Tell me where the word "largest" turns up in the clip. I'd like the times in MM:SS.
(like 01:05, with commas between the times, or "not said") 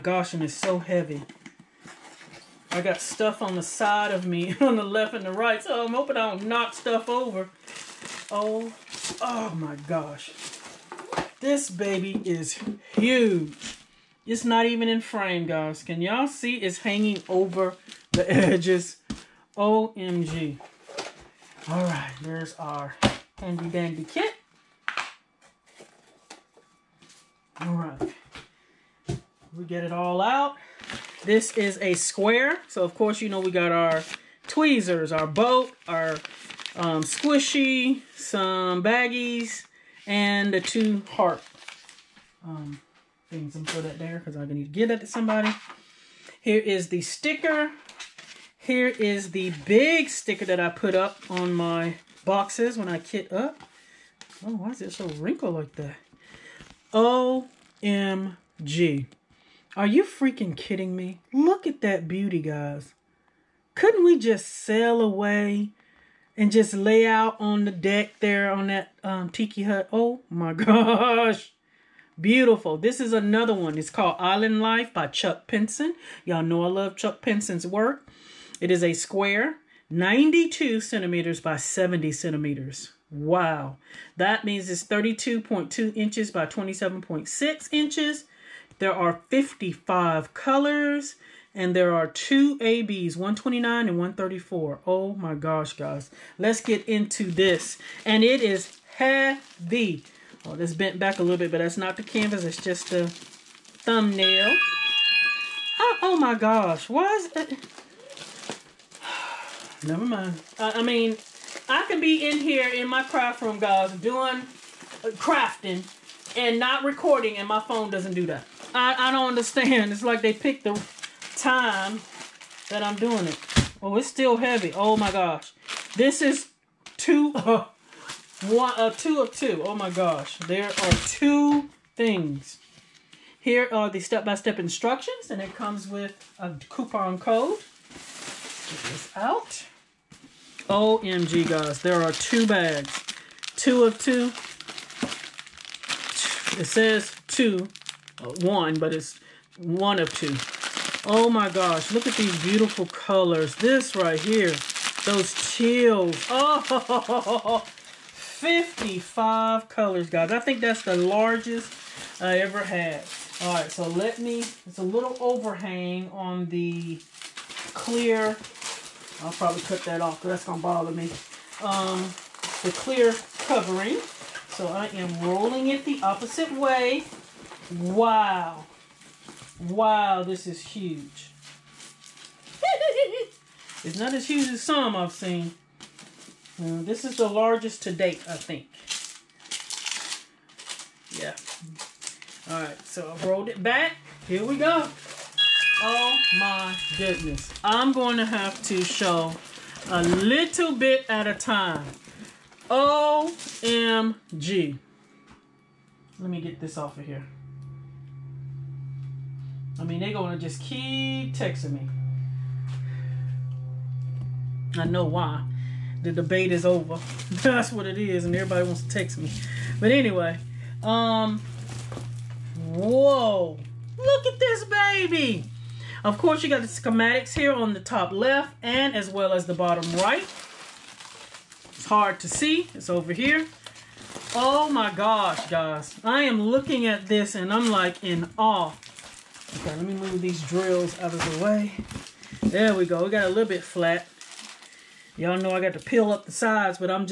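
02:40, 03:07.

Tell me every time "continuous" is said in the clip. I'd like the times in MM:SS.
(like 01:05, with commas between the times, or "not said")
not said.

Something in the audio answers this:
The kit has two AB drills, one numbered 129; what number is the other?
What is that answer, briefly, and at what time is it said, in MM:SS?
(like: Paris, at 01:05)
134, at 01:33.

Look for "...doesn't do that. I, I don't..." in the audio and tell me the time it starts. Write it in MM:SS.
01:57.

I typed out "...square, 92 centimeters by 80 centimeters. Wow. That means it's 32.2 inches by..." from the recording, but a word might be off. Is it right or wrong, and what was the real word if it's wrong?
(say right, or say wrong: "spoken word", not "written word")
wrong: "70", not "80".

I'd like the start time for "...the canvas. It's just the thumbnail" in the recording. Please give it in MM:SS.
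01:41.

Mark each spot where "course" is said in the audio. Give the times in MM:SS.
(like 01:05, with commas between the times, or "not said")
00:32, 03:46.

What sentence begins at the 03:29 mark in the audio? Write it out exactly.
I mean, they're going to just keep texting me.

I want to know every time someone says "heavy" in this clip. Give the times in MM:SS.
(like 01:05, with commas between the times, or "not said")
00:00, 01:38, 02:04.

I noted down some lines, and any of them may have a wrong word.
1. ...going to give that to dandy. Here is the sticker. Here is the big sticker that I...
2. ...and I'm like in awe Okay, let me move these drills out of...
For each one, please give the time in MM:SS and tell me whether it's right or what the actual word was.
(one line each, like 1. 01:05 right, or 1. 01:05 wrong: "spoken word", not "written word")
1. 00:44 wrong: "somebody", not "dandy"
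2. 03:57 right.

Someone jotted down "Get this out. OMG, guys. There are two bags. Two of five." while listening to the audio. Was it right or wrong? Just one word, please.
wrong.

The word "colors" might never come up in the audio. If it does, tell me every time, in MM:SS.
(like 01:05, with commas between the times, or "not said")
01:30, 02:32, 02:39.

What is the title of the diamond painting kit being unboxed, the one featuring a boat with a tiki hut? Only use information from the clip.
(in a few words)
Island Life.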